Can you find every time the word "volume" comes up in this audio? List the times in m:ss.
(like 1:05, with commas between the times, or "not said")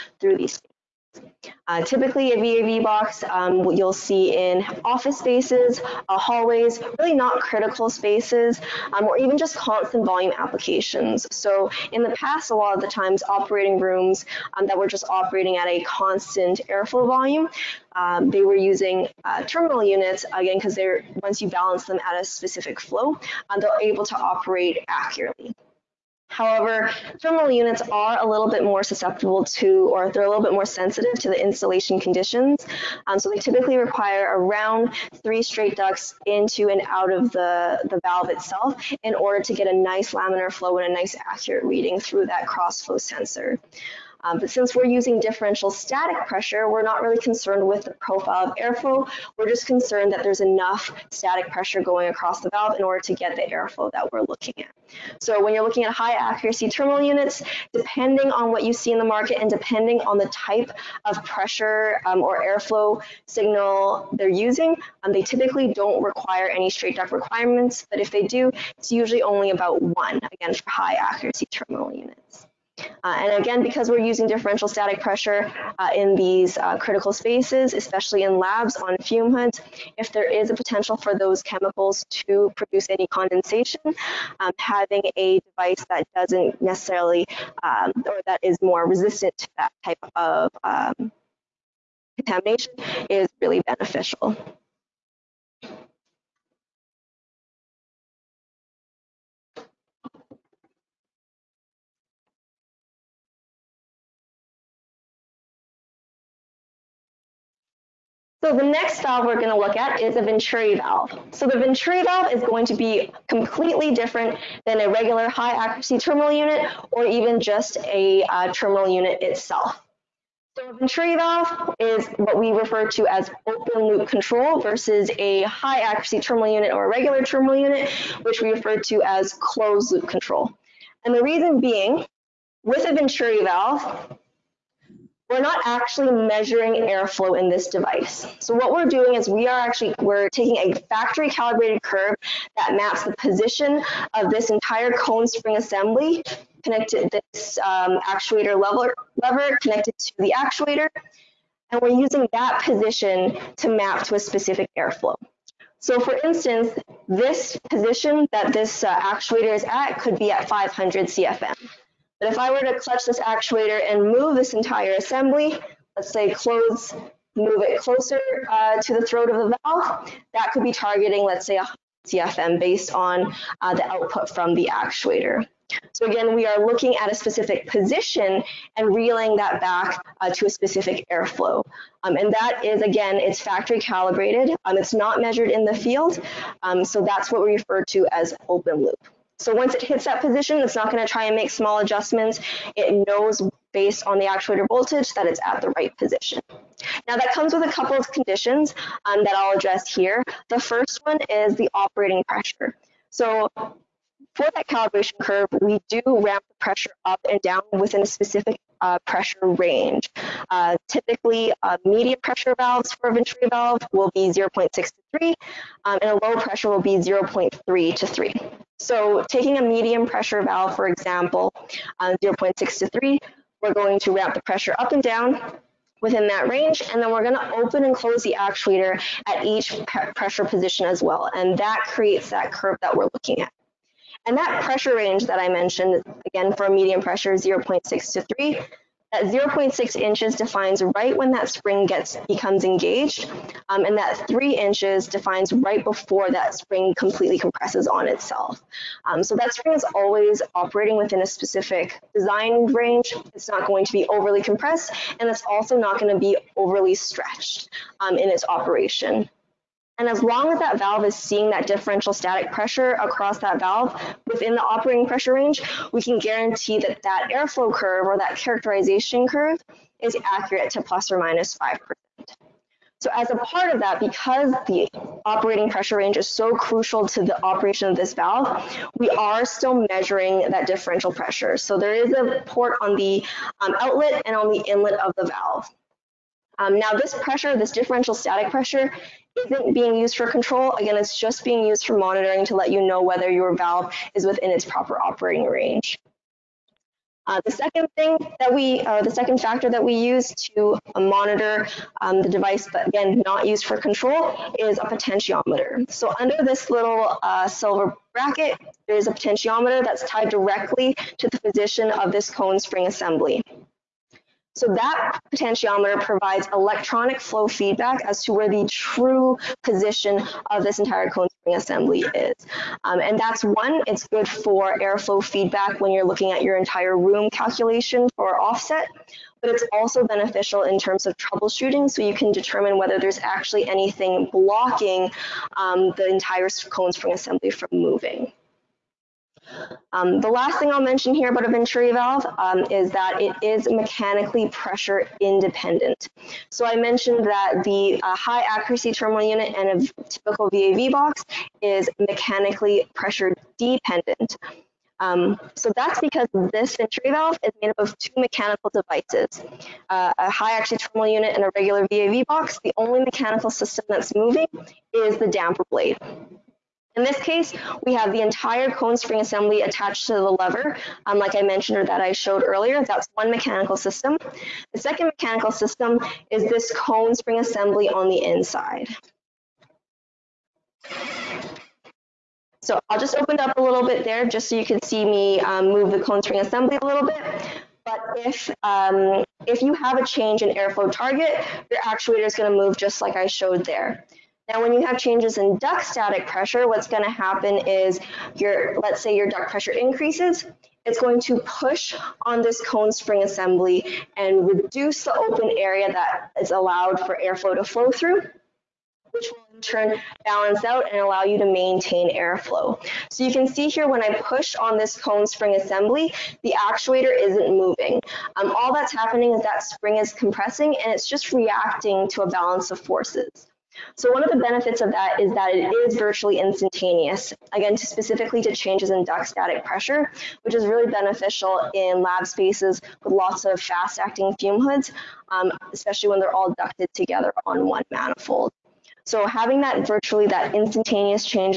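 0:10, 0:17.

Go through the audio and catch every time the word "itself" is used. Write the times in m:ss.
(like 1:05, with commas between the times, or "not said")
0:38, 1:59, 4:08.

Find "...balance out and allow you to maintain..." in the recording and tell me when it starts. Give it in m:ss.
6:50.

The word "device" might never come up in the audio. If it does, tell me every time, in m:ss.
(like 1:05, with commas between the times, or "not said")
1:25, 2:17, 5:02, 5:58.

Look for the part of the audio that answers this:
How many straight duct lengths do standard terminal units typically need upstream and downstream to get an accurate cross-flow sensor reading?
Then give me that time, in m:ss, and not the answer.
0:35.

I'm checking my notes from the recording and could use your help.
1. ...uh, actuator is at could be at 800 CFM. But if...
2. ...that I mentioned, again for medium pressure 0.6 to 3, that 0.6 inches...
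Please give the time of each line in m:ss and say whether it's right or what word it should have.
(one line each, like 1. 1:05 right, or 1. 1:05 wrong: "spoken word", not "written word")
1. 2:38 wrong: "500", not "800"
2. 3:55 right.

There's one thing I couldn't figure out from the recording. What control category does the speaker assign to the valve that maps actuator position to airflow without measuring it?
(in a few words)
Open loop control.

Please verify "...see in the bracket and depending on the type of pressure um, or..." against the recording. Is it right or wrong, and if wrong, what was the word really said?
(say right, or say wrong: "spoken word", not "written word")
wrong: "market", not "bracket".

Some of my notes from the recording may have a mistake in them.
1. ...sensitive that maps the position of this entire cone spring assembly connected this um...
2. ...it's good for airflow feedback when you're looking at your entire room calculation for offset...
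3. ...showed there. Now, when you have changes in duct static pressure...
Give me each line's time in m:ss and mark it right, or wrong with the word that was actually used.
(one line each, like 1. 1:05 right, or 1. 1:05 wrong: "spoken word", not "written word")
1. 2:21 wrong: "curve", not "sensitive"
2. 5:23 right
3. 6:33 right.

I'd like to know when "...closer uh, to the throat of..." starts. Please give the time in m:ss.
2:47.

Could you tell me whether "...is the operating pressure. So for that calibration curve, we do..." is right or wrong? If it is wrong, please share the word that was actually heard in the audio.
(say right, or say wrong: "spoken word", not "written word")
right.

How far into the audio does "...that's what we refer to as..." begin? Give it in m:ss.
3:07.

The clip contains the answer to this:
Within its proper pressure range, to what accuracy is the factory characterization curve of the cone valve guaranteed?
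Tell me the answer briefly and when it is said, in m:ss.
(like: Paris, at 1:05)
plus or minus 5%, at 4:30.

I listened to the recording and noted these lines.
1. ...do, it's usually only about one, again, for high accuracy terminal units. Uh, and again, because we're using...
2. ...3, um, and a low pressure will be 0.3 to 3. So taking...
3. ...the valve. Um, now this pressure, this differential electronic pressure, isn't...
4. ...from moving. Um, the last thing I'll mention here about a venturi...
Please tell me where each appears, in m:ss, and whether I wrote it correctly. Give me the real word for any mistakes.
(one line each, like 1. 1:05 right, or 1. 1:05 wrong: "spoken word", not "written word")
1. 1:08 right
2. 3:35 right
3. 4:45 wrong: "static", not "electronic"
4. 5:37 right.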